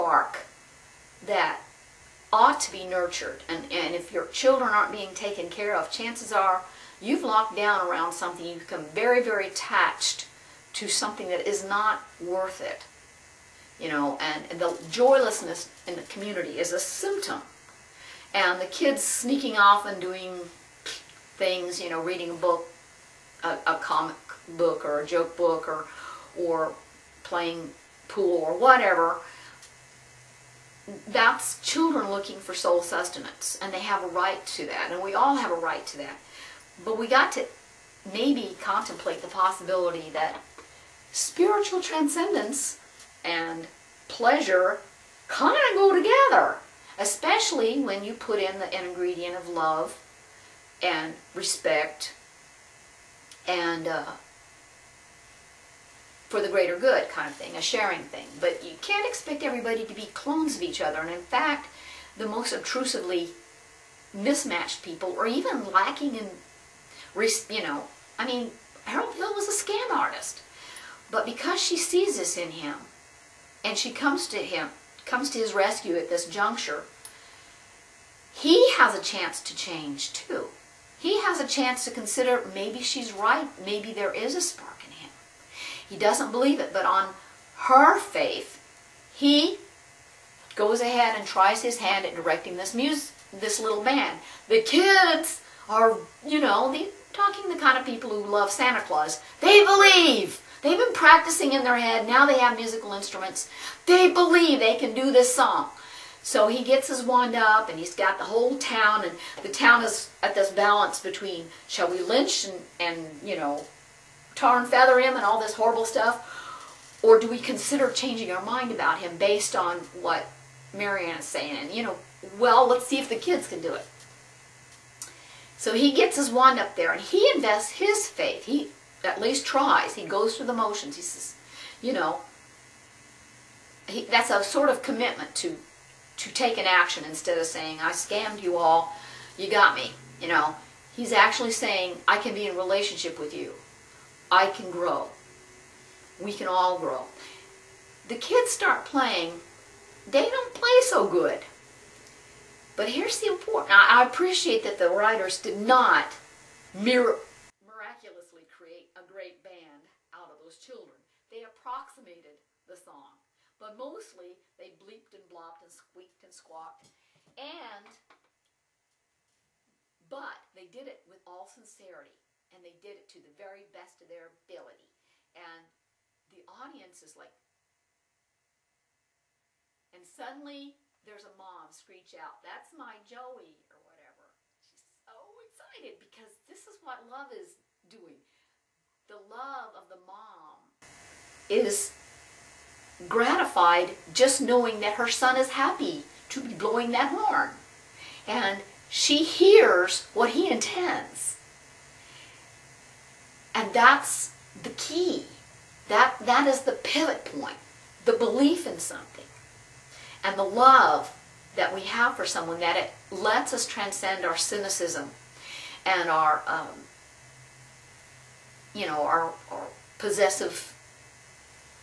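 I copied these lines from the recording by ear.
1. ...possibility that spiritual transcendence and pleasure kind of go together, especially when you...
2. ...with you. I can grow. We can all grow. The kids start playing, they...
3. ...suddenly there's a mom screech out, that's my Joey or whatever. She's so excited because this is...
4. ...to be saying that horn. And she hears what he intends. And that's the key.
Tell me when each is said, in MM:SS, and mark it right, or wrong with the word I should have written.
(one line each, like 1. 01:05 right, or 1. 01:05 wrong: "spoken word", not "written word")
1. 00:39 right
2. 02:23 right
3. 03:00 right
4. 03:16 wrong: "blowing", not "saying".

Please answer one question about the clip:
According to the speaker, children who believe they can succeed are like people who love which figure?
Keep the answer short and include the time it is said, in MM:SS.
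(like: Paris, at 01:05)
Santa Claus, at 01:38.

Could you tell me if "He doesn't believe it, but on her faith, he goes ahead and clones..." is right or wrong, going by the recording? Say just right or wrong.
wrong.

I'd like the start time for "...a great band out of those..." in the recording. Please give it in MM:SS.
02:38.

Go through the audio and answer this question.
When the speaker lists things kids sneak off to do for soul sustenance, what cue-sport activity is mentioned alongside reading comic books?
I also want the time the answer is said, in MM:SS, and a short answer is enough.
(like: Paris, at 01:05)
playing pool, at 00:27.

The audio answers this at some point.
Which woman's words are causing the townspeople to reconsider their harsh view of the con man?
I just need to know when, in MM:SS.
02:00.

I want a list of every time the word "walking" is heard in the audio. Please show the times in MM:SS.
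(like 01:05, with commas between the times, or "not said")
not said.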